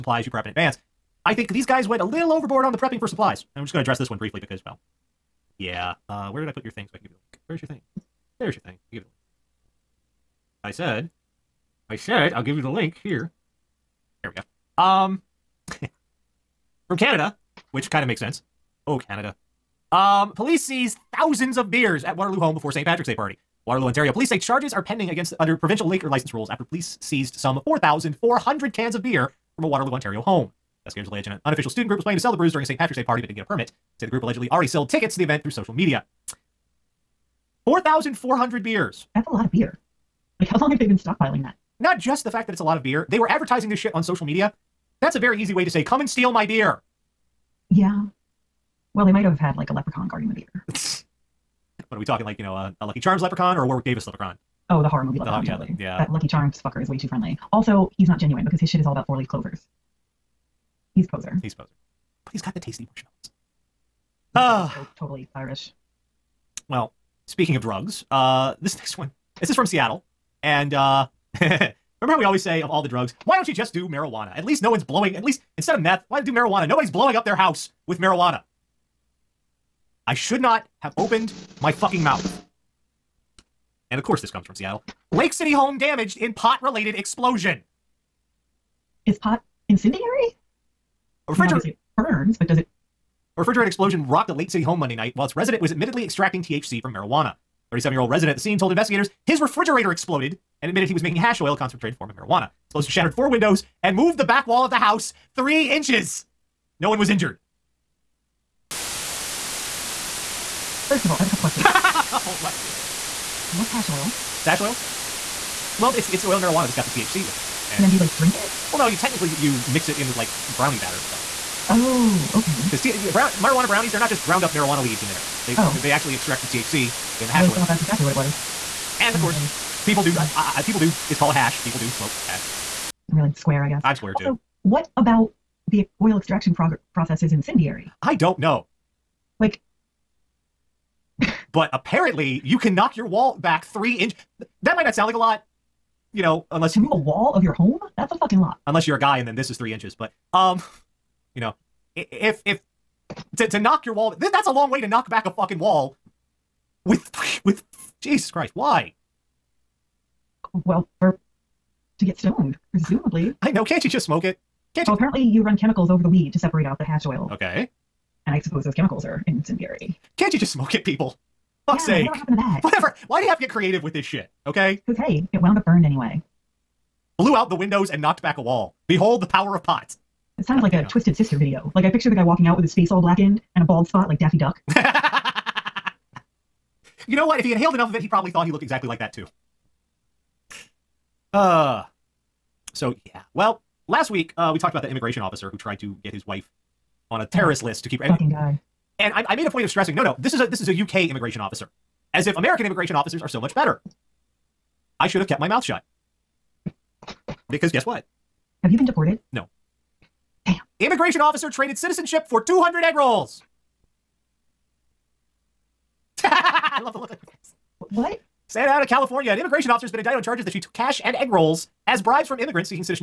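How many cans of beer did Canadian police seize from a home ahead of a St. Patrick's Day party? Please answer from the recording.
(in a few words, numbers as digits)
4,400.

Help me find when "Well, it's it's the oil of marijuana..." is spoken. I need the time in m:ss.
1:55.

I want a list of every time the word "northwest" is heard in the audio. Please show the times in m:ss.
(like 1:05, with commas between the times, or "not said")
not said.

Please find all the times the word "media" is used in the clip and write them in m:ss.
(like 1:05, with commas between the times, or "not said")
0:35, 0:44.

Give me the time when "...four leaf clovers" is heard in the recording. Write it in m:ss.
0:59.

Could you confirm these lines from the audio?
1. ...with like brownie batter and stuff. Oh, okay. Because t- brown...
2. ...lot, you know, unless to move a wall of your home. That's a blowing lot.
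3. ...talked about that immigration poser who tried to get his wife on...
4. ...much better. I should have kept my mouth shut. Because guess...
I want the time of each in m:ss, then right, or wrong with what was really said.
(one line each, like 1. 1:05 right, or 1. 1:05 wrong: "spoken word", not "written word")
1. 2:00 right
2. 2:25 wrong: "fucking", not "blowing"
3. 3:14 wrong: "officer", not "poser"
4. 3:23 right.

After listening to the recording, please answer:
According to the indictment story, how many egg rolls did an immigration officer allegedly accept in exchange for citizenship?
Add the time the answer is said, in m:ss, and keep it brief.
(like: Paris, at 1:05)
200, at 3:32.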